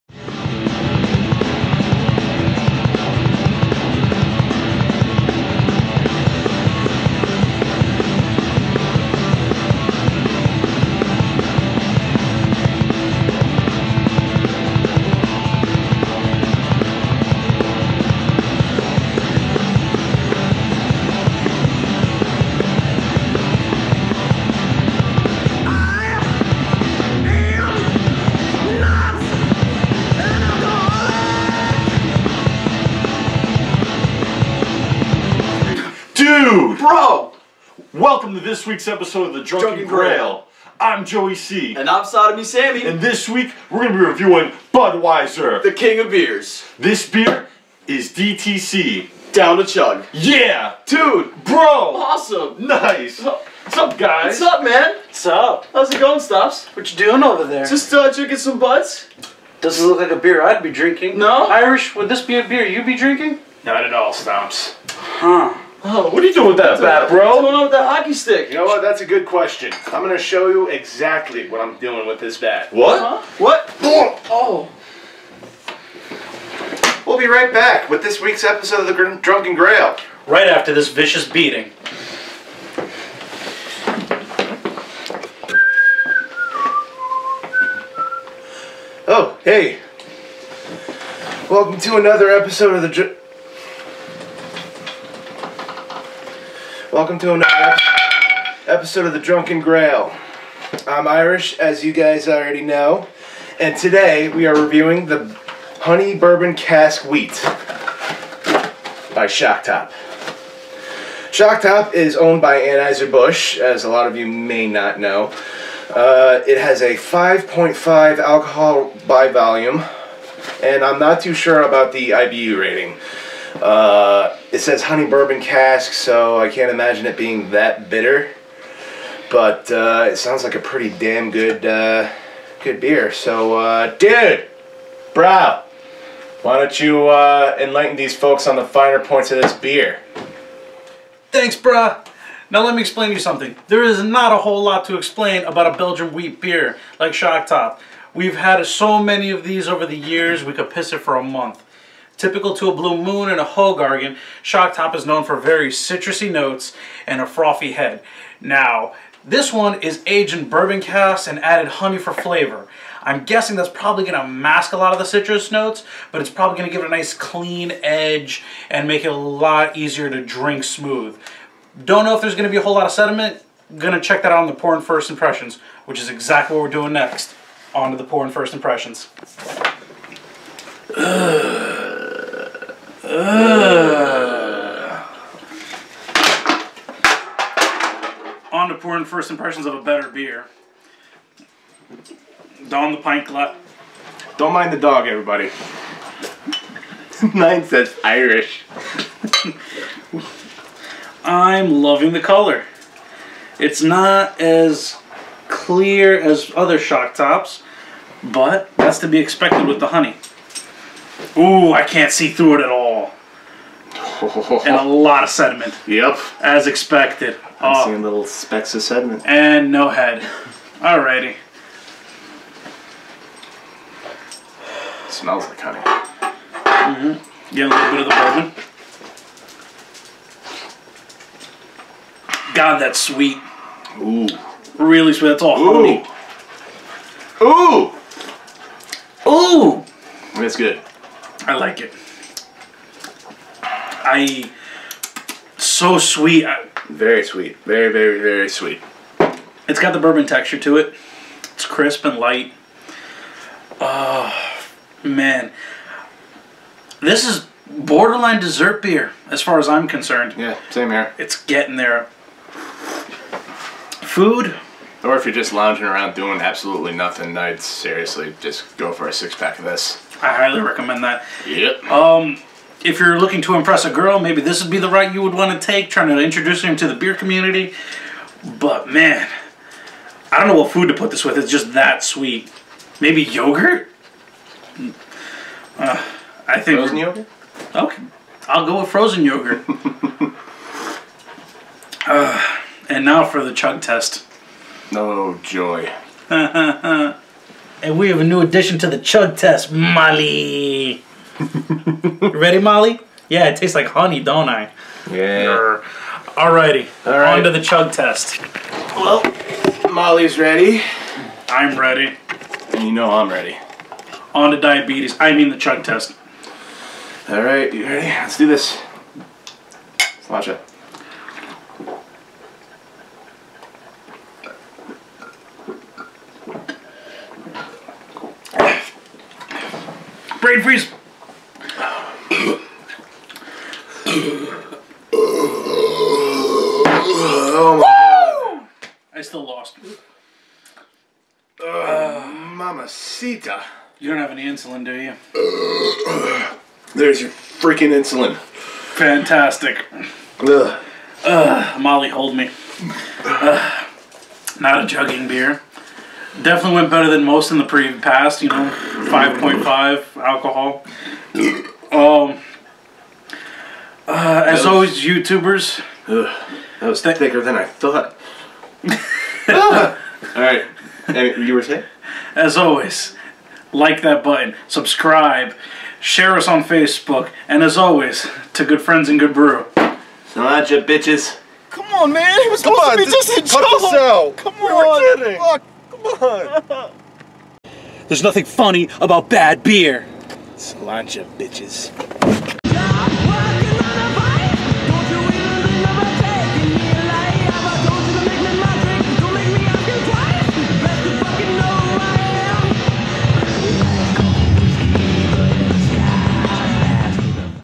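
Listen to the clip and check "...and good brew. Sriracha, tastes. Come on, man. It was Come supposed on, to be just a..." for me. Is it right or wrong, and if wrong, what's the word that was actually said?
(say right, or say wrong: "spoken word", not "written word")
wrong: "bitches", not "tastes".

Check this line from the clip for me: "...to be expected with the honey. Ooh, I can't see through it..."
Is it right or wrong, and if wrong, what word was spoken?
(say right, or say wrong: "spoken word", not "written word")
right.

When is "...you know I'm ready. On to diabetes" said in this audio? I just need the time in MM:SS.
05:12.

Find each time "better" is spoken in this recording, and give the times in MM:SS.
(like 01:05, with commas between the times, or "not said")
03:09, 05:56.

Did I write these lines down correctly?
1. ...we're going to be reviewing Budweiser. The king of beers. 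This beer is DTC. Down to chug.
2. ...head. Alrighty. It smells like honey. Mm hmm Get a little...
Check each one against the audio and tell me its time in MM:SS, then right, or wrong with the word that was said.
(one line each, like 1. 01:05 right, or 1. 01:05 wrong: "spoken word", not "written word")
1. 00:43 right
2. 03:39 right.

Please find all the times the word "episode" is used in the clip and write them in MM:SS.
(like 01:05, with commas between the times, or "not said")
00:38, 01:18, 01:32, 01:38.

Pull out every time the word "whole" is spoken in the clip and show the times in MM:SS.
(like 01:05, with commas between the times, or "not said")
02:24, 02:52.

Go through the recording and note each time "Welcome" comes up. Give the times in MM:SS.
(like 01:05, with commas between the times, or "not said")
00:38, 01:31, 01:36.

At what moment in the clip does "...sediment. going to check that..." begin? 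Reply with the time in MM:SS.
02:52.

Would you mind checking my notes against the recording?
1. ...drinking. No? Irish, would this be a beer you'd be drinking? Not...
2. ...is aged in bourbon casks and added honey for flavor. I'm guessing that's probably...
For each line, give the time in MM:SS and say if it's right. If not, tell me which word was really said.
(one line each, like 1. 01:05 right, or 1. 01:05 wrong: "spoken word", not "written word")
1. 01:00 right
2. 02:39 right.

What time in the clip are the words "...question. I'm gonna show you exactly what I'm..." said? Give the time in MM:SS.
01:09.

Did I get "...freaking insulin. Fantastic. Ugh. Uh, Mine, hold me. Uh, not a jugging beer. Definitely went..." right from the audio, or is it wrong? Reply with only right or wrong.
wrong.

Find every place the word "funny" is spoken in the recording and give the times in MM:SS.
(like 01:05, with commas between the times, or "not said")
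06:28.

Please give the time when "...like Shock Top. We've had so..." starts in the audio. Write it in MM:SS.
02:26.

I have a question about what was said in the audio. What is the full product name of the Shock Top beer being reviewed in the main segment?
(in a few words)
Honey Bourbon Cask Wheat.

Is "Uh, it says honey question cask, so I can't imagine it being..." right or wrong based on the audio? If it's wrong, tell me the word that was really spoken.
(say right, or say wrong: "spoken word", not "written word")
wrong: "bourbon", not "question".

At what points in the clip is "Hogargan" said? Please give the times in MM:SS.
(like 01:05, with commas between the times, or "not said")
02:33.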